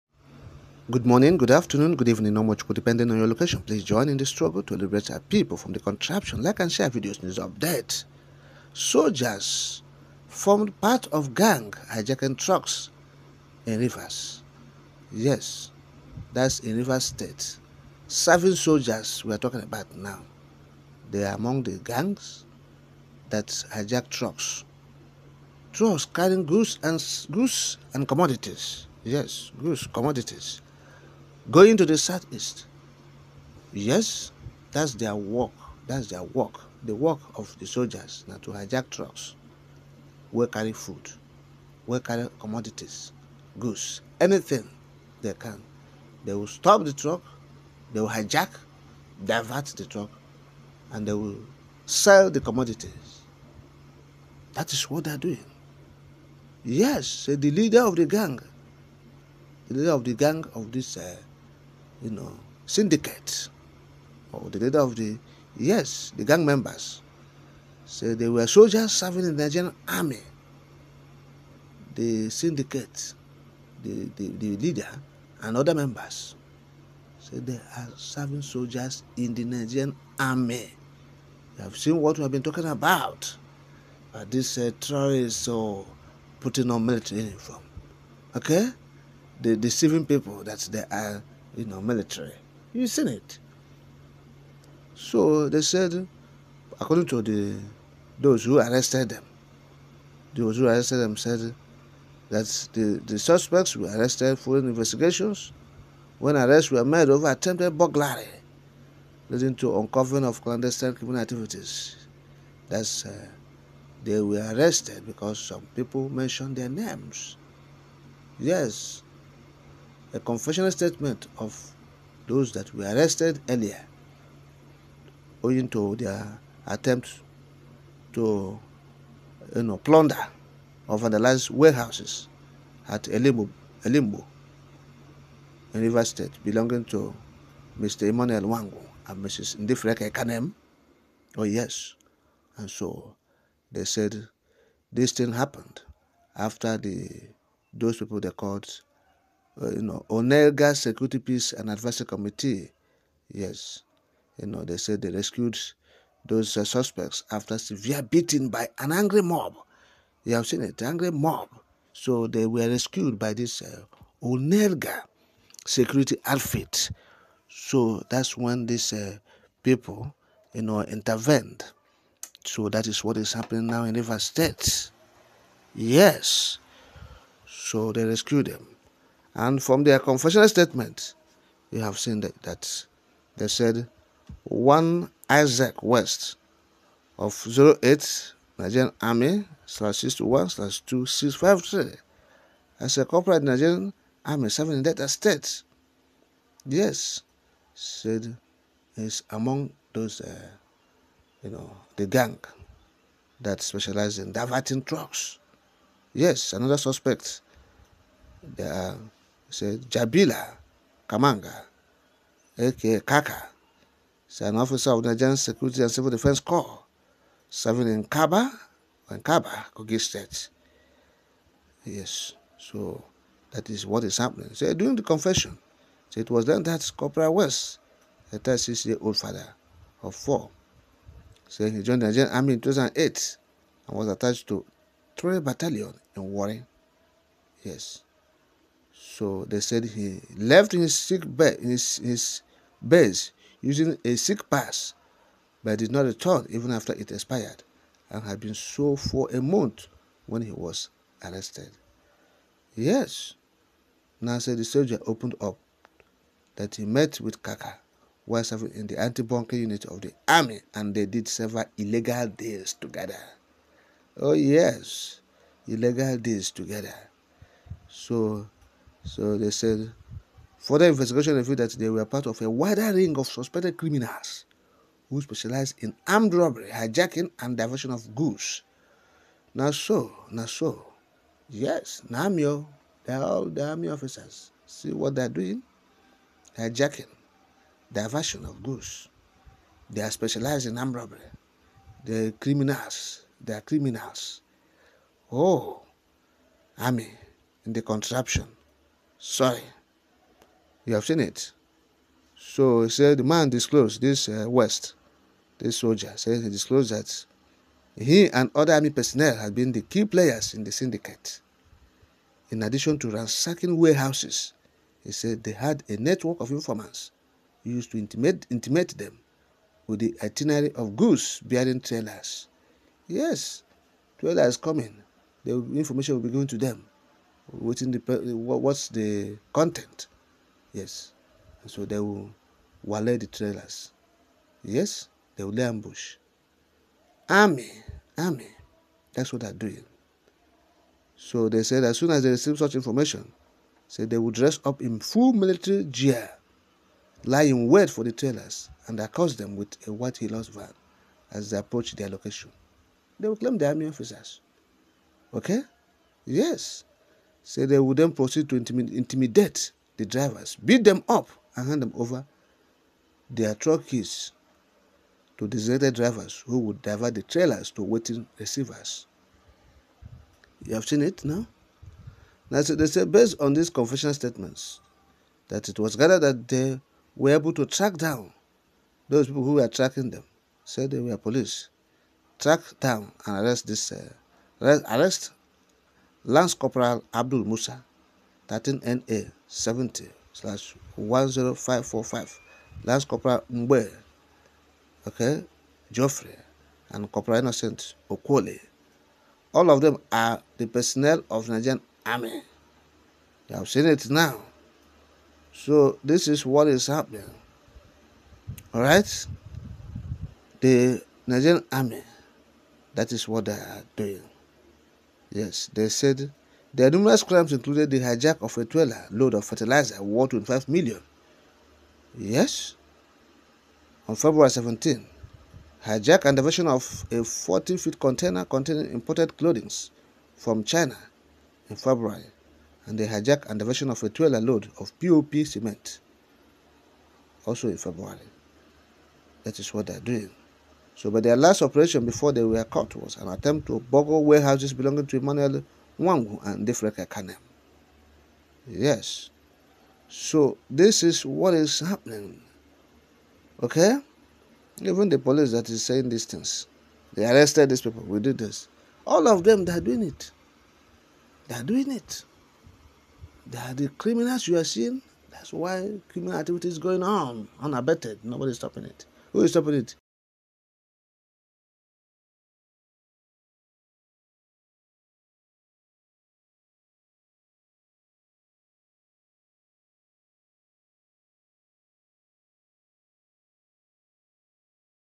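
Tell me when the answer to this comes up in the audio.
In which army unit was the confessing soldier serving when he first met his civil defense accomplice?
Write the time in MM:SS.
04:18.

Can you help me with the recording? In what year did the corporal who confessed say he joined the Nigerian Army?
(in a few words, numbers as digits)
2008.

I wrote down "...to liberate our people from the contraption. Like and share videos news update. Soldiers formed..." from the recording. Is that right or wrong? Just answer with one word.
right.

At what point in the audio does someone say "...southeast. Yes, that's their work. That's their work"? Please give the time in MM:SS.
00:31.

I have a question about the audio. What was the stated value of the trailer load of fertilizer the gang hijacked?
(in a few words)
25 million.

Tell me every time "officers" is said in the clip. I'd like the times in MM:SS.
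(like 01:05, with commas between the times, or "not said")
03:34, 04:43, 05:53.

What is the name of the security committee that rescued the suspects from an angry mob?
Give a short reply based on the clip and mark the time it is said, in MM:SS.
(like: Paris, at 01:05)
Onelga Security Peace and Advisory Committee, at 02:30.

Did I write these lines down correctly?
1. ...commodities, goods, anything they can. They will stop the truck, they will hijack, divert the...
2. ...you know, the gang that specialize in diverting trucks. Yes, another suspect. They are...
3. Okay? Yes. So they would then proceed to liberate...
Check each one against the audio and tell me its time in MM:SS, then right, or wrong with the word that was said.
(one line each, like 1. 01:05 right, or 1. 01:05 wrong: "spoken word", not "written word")
1. 00:42 right
2. 03:21 right
3. 05:55 wrong: "intimidate", not "liberate".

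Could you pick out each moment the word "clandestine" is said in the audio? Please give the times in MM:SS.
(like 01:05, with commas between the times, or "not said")
01:50.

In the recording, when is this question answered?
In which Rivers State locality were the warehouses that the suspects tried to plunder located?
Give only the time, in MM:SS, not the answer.
02:13.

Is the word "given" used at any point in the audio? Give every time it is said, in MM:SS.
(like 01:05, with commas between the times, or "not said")
05:26.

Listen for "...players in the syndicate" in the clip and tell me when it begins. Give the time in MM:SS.
05:10.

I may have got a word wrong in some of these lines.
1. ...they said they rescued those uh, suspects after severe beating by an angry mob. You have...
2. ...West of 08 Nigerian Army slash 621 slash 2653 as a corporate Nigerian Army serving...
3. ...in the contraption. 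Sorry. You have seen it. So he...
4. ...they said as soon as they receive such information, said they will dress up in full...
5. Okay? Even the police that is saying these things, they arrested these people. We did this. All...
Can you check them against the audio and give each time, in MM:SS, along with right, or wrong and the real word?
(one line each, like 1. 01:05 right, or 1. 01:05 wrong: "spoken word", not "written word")
1. 02:34 right
2. 03:05 right
3. 04:57 right
4. 05:41 right
5. 07:33 right.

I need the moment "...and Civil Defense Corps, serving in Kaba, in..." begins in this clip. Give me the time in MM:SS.
03:35.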